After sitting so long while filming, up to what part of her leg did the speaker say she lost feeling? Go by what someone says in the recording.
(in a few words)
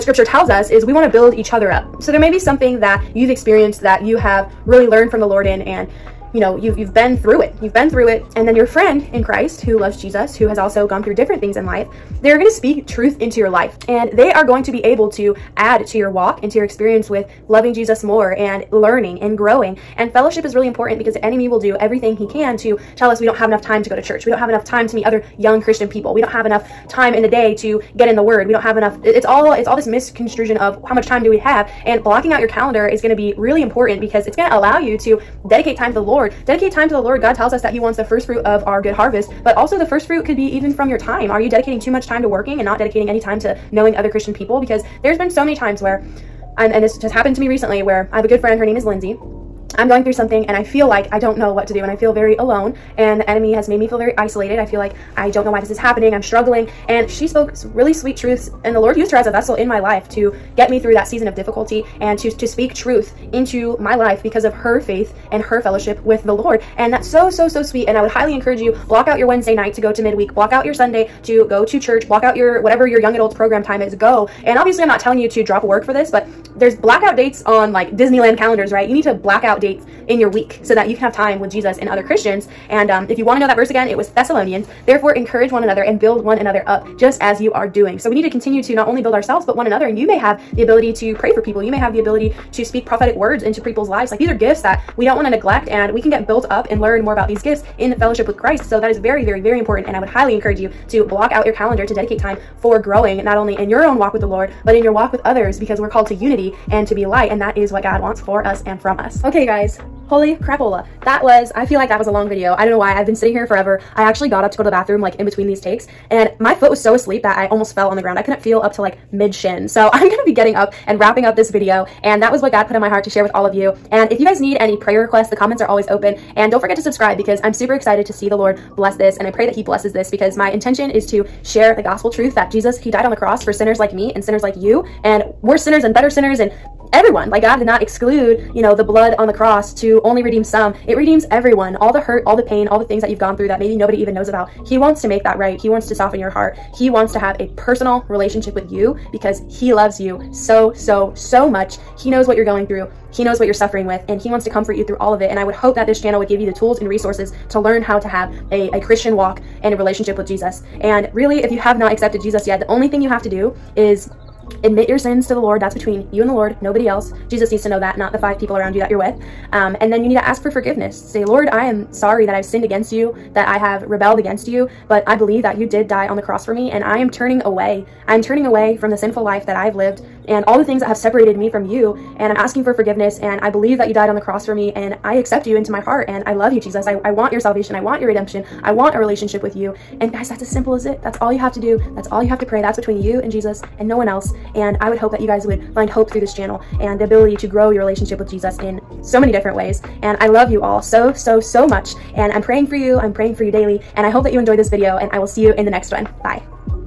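mid shin.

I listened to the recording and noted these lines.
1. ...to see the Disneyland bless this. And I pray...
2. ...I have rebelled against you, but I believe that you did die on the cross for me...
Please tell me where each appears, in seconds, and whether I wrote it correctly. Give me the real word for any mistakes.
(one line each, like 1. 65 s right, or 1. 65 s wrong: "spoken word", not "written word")
1. 128 s wrong: "Lord", not "Disneyland"
2. 173 s right.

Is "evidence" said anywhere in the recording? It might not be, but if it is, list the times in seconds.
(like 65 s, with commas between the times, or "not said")
not said.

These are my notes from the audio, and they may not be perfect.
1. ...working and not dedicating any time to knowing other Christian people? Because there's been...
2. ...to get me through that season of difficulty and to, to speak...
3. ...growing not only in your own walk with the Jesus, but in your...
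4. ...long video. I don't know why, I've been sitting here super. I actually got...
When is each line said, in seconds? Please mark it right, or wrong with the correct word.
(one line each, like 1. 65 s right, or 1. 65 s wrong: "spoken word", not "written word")
1. 42 s right
2. 60 s right
3. 102 s wrong: "Lord", not "Jesus"
4. 112 s wrong: "forever", not "super".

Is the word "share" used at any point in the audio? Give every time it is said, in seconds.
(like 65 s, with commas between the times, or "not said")
123 s, 131 s.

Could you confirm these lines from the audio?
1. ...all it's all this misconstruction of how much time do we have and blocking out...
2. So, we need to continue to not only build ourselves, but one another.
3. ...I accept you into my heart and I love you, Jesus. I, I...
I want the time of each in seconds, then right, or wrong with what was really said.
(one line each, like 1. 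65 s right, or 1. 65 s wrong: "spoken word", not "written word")
1. 29 s right
2. 87 s right
3. 185 s right.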